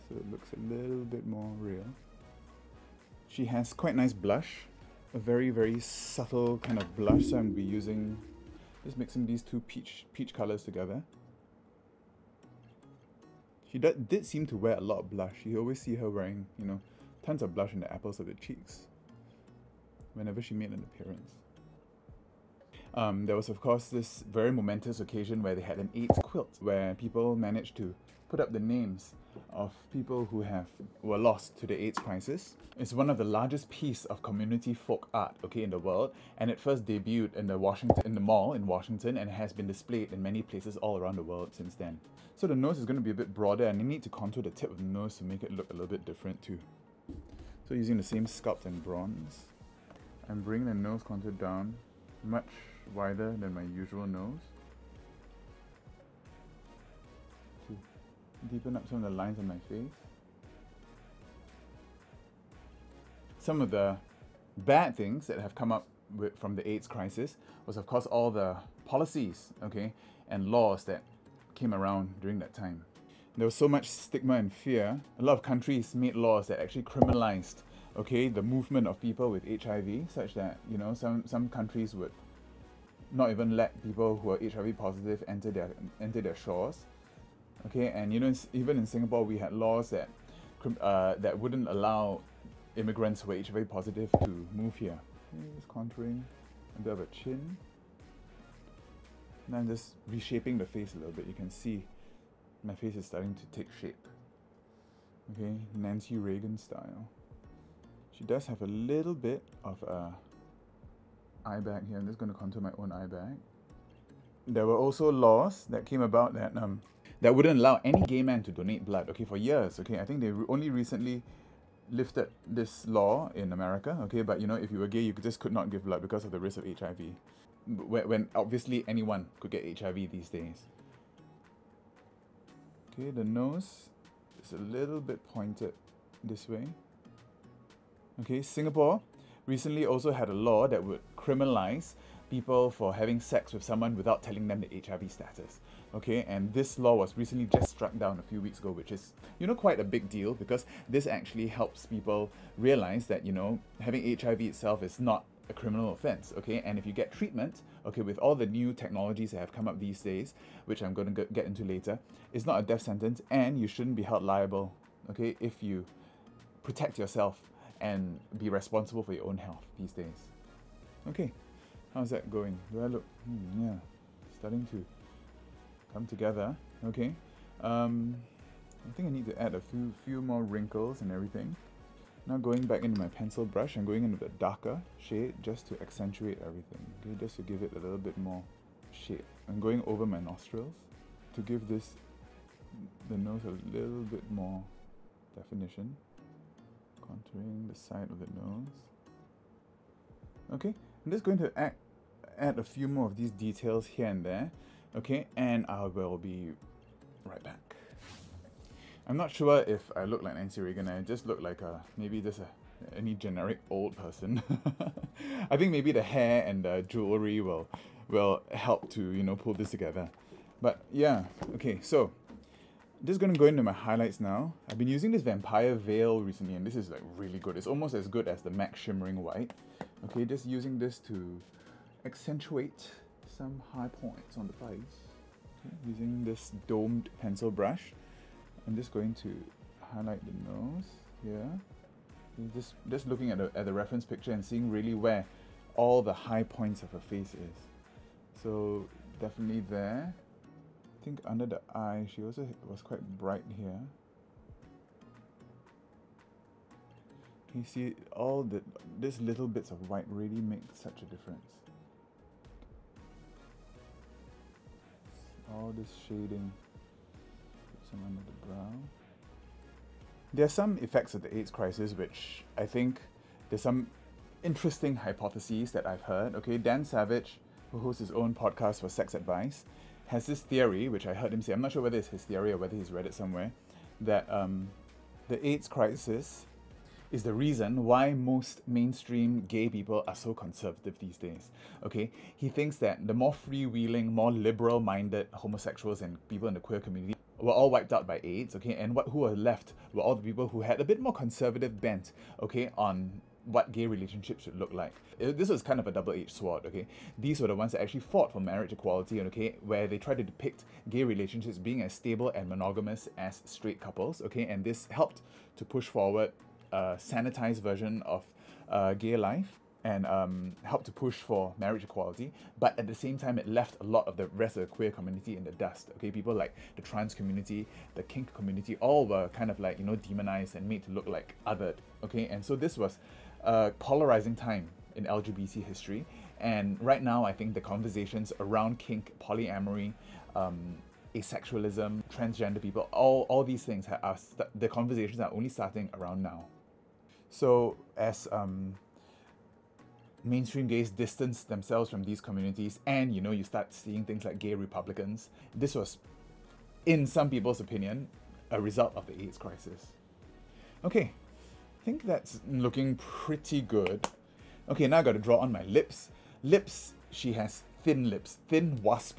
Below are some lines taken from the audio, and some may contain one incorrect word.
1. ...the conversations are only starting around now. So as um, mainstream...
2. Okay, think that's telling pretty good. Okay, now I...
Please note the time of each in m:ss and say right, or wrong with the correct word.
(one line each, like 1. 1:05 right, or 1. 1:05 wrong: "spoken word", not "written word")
1. 5:44 right
2. 6:00 wrong: "looking", not "telling".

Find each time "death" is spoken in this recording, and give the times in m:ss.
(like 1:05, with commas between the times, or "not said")
2:42.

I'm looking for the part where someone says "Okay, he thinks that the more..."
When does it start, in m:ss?
4:51.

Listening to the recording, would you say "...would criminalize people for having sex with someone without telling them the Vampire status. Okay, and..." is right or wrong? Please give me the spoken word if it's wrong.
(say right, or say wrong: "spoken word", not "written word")
wrong: "HIV", not "Vampire".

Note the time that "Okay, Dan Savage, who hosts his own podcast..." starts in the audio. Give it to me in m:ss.
4:36.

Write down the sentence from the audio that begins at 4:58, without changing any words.
Okay, and what who are left were all the people who had a bit more conservative bent.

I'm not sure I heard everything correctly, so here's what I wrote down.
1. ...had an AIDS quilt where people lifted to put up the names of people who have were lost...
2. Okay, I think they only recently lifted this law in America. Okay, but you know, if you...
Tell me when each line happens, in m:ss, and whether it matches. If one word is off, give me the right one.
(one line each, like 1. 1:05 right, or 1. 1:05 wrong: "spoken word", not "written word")
1. 0:25 wrong: "managed", not "lifted"
2. 1:59 right.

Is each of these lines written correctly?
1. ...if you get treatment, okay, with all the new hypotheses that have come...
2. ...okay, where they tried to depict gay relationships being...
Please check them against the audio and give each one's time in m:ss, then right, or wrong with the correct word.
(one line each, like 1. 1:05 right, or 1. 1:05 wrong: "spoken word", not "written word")
1. 2:36 wrong: "technologies", not "hypotheses"
2. 5:09 right.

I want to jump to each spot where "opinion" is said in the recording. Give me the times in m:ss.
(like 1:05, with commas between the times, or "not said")
5:57.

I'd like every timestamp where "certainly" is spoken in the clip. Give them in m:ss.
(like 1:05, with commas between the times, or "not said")
not said.